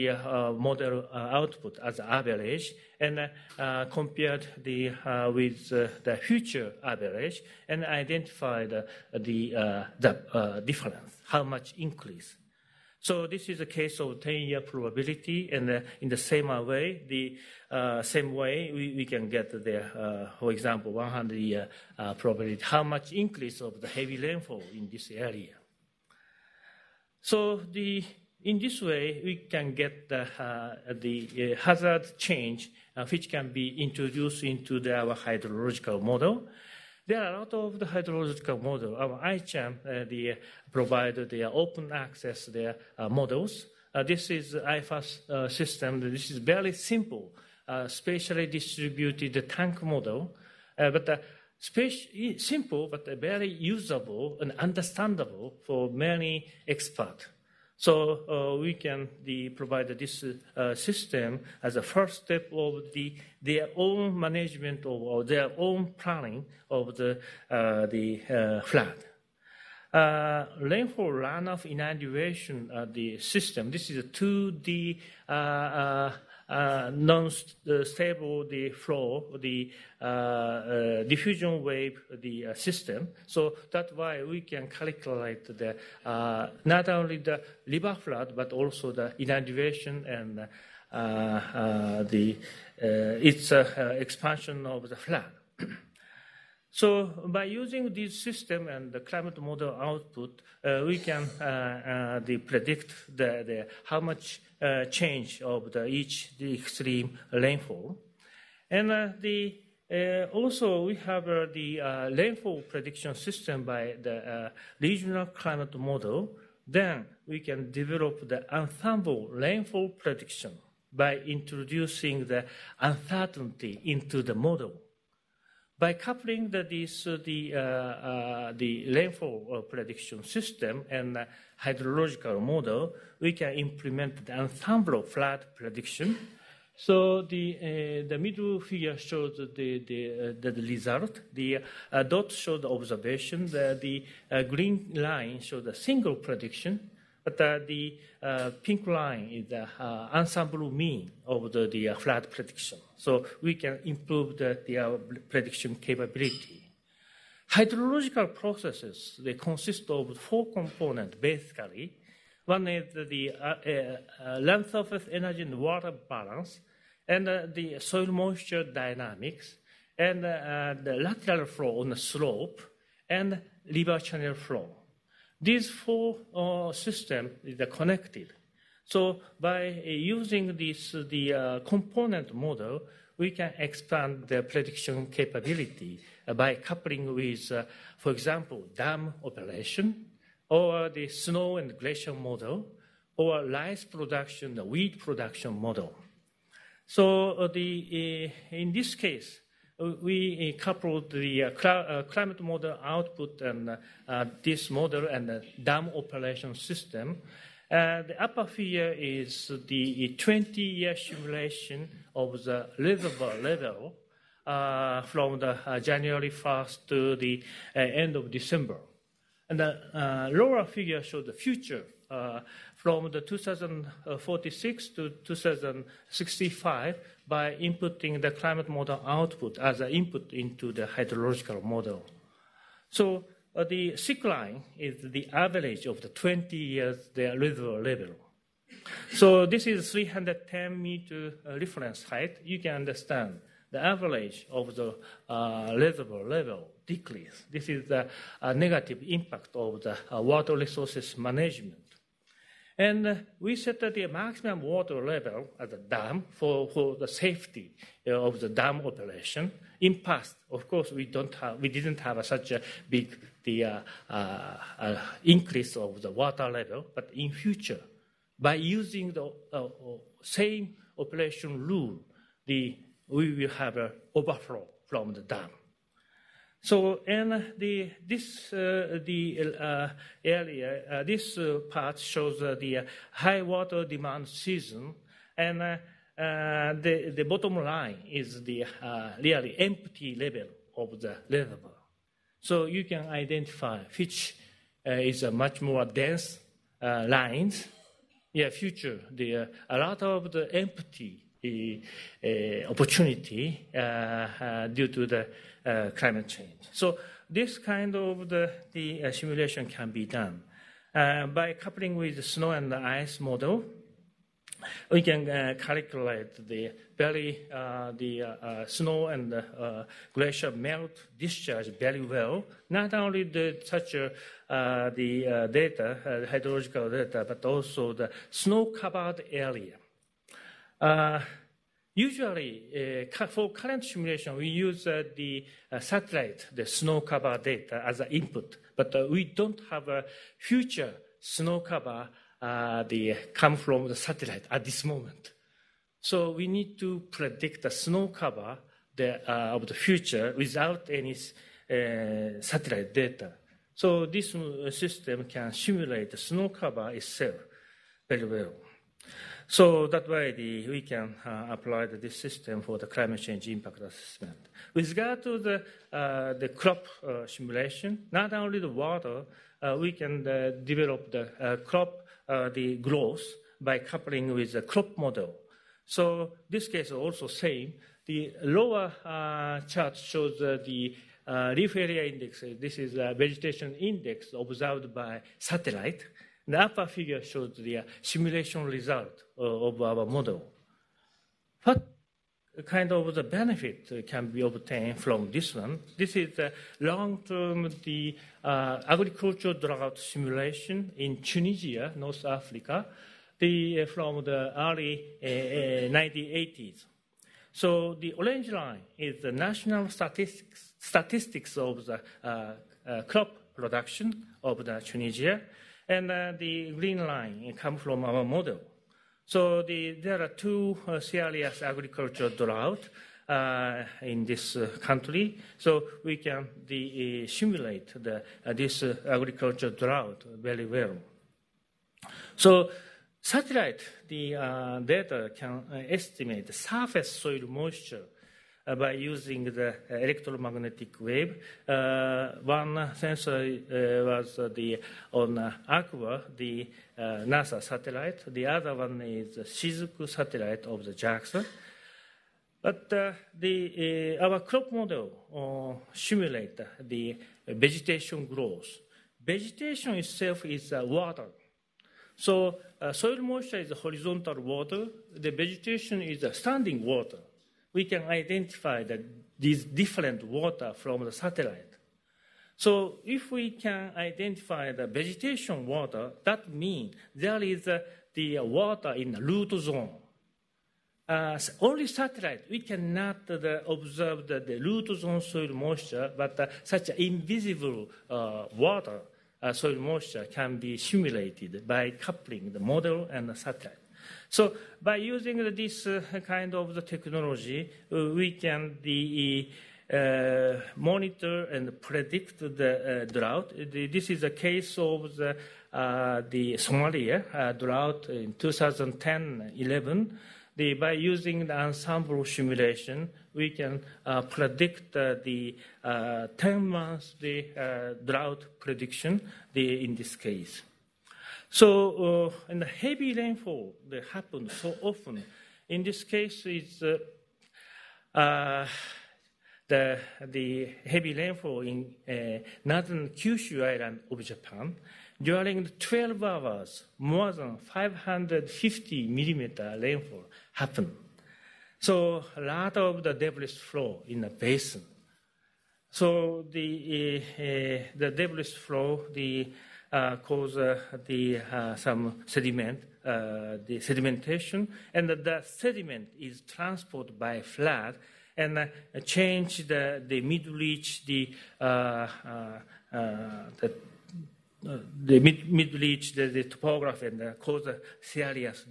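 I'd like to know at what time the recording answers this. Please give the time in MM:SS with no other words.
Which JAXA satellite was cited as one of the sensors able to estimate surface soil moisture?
07:29.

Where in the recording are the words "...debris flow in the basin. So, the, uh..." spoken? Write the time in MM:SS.
09:03.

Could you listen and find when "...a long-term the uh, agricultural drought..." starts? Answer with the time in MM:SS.
06:36.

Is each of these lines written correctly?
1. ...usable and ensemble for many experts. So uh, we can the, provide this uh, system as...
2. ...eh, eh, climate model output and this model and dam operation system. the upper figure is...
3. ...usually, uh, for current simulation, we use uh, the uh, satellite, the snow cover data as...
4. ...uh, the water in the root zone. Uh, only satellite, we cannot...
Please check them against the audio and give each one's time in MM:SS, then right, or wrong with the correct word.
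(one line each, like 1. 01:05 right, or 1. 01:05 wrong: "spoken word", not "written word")
1. 00:53 wrong: "understandable", not "ensemble"
2. 03:21 right
3. 05:31 right
4. 07:57 right.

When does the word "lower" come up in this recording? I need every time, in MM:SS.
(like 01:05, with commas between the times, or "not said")
03:40, 06:18.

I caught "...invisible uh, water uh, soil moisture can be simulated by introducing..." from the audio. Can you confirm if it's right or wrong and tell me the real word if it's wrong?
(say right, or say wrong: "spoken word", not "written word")
wrong: "coupling", not "introducing".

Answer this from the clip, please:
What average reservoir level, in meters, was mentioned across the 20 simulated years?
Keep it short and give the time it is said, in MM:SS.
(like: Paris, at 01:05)
310 meters, at 03:59.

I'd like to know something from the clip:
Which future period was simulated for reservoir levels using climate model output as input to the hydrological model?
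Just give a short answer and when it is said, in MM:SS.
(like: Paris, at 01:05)
2046 to 2065, at 03:43.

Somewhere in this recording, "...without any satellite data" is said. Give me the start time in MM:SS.
05:50.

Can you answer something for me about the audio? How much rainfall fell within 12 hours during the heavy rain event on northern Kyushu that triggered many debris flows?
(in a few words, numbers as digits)
More than 550 mm.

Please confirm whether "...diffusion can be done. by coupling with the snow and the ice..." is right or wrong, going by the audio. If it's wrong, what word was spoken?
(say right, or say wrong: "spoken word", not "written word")
wrong: "simulation", not "diffusion".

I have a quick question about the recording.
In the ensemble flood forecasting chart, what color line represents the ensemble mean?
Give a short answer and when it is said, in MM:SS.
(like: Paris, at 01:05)
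Pink, at 02:28.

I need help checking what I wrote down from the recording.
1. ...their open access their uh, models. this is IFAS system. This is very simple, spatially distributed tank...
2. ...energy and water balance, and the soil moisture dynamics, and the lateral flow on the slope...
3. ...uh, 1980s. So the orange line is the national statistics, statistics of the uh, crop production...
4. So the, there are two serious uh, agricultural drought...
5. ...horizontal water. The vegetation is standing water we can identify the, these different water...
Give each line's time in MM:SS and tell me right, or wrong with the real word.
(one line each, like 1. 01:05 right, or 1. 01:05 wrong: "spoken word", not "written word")
1. 00:41 right
2. 02:45 right
3. 06:45 right
4. 06:59 right
5. 07:43 right.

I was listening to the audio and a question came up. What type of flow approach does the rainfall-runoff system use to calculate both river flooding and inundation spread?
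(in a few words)
diffusion wave.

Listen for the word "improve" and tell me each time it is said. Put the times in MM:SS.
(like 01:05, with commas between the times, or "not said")
02:33.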